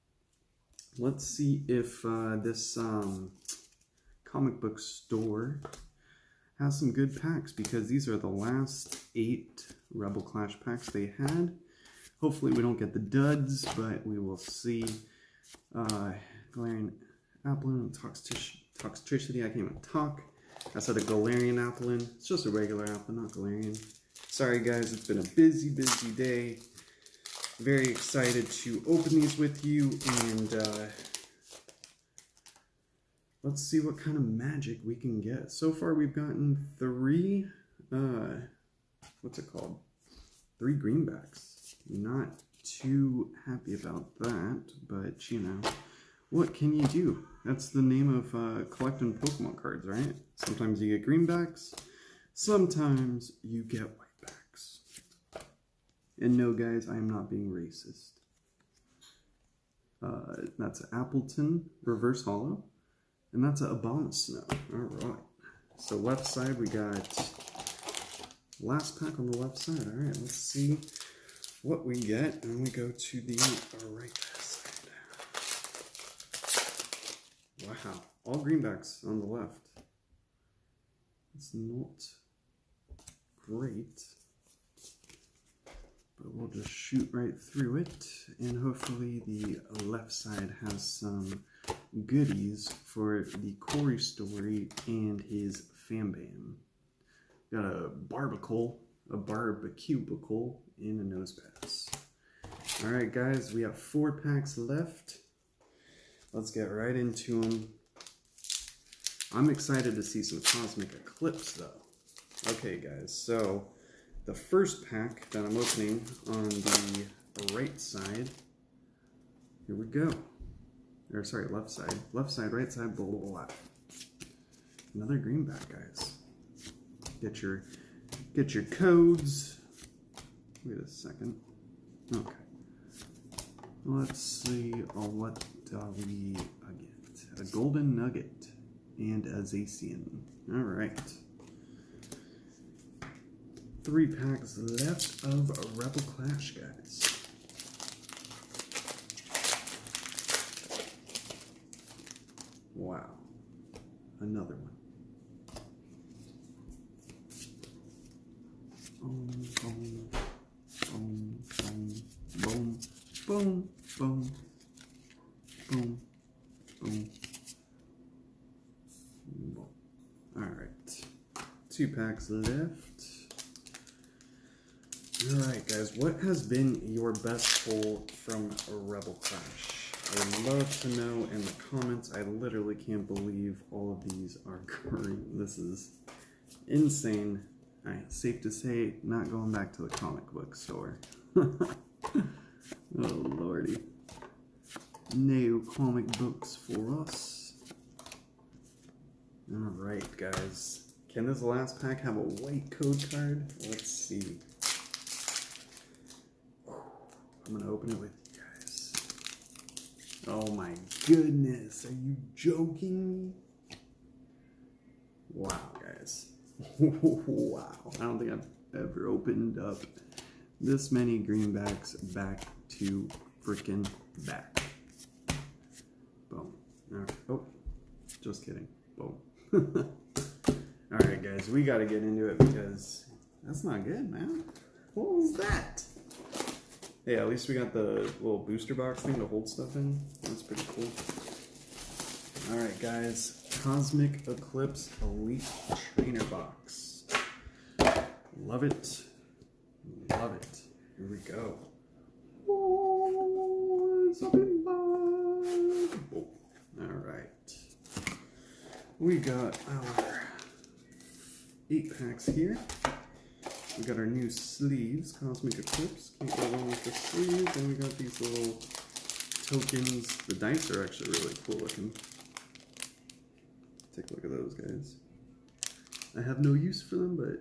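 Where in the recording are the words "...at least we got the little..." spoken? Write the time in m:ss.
3:57.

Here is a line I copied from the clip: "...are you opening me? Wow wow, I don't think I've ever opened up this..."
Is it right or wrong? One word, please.
wrong.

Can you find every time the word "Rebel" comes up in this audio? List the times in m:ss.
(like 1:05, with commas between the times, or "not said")
0:09, 2:25, 2:58.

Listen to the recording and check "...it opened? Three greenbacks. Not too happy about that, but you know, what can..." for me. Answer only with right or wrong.
wrong.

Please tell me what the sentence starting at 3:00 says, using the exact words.
I would love to know in the comments.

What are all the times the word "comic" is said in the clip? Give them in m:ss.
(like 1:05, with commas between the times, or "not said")
0:04, 3:09, 3:15.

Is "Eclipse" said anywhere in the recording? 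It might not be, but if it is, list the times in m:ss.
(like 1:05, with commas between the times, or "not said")
1:50, 4:04, 4:25.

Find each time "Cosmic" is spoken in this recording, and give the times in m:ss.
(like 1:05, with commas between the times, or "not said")
1:50, 4:03, 4:25.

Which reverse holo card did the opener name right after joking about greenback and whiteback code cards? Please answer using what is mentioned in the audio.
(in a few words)
Appletun.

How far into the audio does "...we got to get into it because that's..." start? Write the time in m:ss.
3:51.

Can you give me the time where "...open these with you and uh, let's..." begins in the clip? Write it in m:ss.
0:28.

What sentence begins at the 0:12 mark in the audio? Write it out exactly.
Hopefully we don't get the duds, but we will see.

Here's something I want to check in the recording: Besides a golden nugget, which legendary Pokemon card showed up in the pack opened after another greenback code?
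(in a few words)
Zacian.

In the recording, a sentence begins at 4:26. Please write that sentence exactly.
Can't go wrong with the sleeves.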